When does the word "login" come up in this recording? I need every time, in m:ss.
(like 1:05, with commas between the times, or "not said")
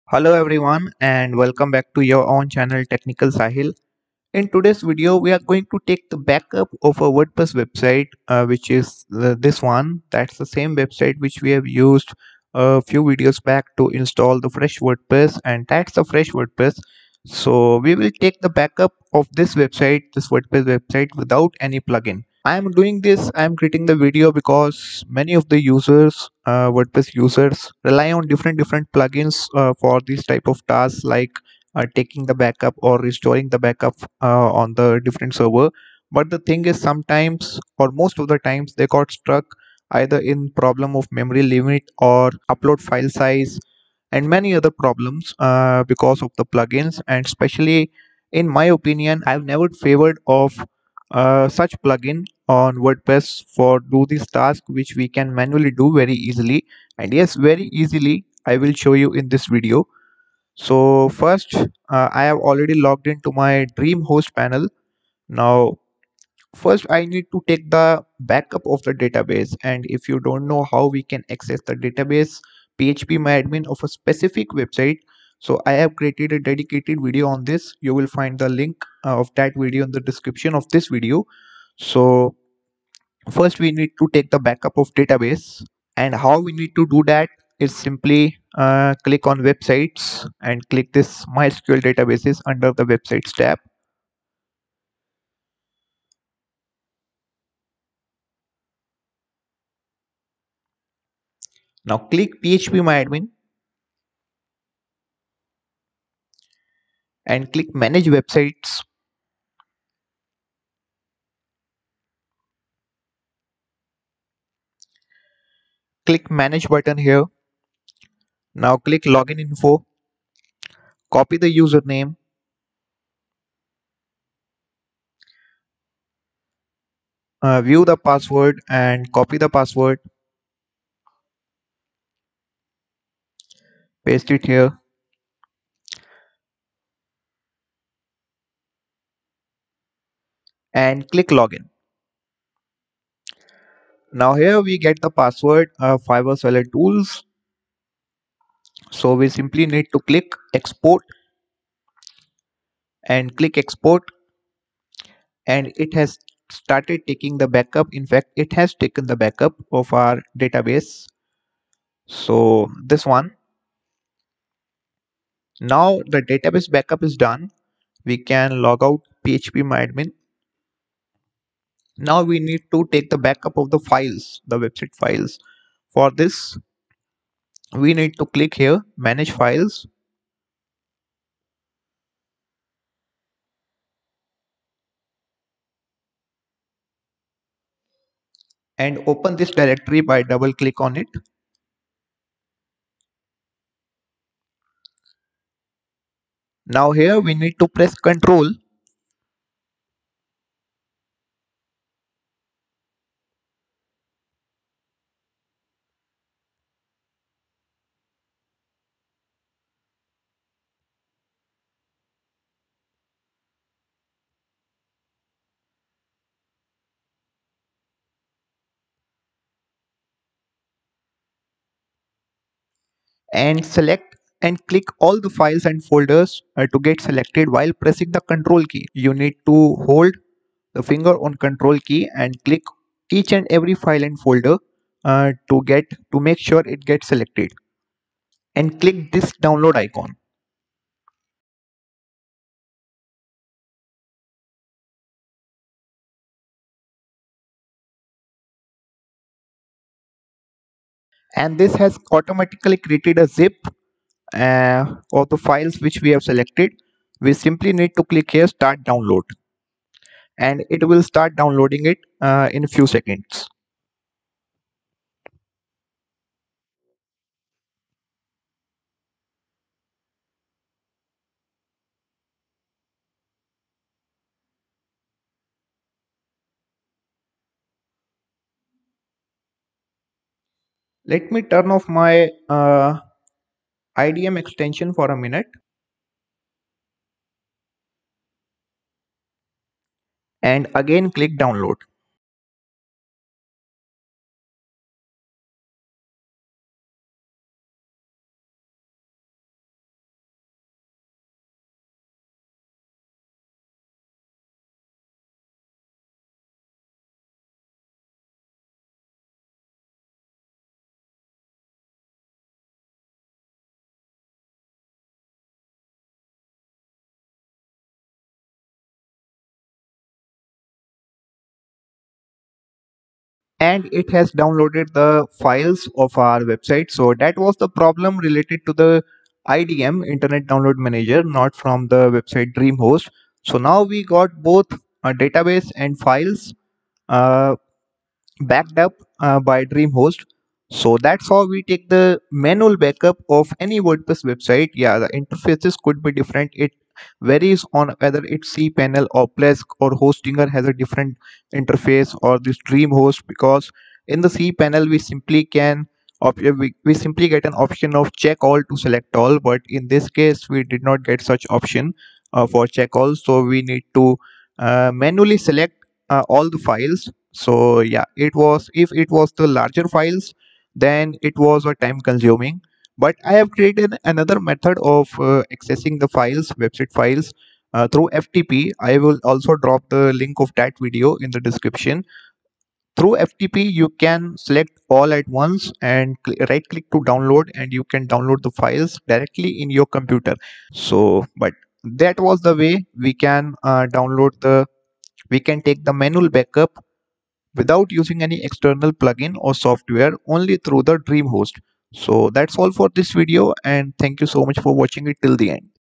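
1:59, 2:21.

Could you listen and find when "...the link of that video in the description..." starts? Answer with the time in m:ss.
6:19.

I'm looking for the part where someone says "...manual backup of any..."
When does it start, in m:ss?
5:42.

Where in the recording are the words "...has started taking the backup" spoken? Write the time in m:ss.
2:35.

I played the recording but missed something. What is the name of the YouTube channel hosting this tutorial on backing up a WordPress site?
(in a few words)
Technical Sahil.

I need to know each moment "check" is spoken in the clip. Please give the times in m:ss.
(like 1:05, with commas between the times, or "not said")
5:58, 6:02.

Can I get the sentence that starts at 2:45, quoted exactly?
Now the database backup is done.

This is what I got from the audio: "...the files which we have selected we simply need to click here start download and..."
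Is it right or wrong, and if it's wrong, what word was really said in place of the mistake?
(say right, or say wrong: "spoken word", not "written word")
right.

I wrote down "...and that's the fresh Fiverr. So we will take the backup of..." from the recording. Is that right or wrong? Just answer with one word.
wrong.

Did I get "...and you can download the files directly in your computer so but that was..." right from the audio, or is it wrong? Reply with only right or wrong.
right.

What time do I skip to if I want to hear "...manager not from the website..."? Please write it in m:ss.
5:30.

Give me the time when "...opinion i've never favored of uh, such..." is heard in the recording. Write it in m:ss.
0:48.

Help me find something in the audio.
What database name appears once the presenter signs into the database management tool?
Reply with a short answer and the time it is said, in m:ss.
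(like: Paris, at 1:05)
Fiverr Seller Tools, at 2:26.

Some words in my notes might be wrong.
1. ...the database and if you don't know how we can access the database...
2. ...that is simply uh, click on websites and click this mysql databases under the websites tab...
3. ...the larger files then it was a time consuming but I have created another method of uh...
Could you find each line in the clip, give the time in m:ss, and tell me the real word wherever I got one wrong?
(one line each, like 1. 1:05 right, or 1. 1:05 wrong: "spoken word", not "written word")
1. 1:08 right
2. 1:27 right
3. 6:09 right.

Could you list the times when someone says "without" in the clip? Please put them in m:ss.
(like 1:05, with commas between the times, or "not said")
0:21, 6:37.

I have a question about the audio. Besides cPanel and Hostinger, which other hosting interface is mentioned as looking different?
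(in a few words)
Plesk.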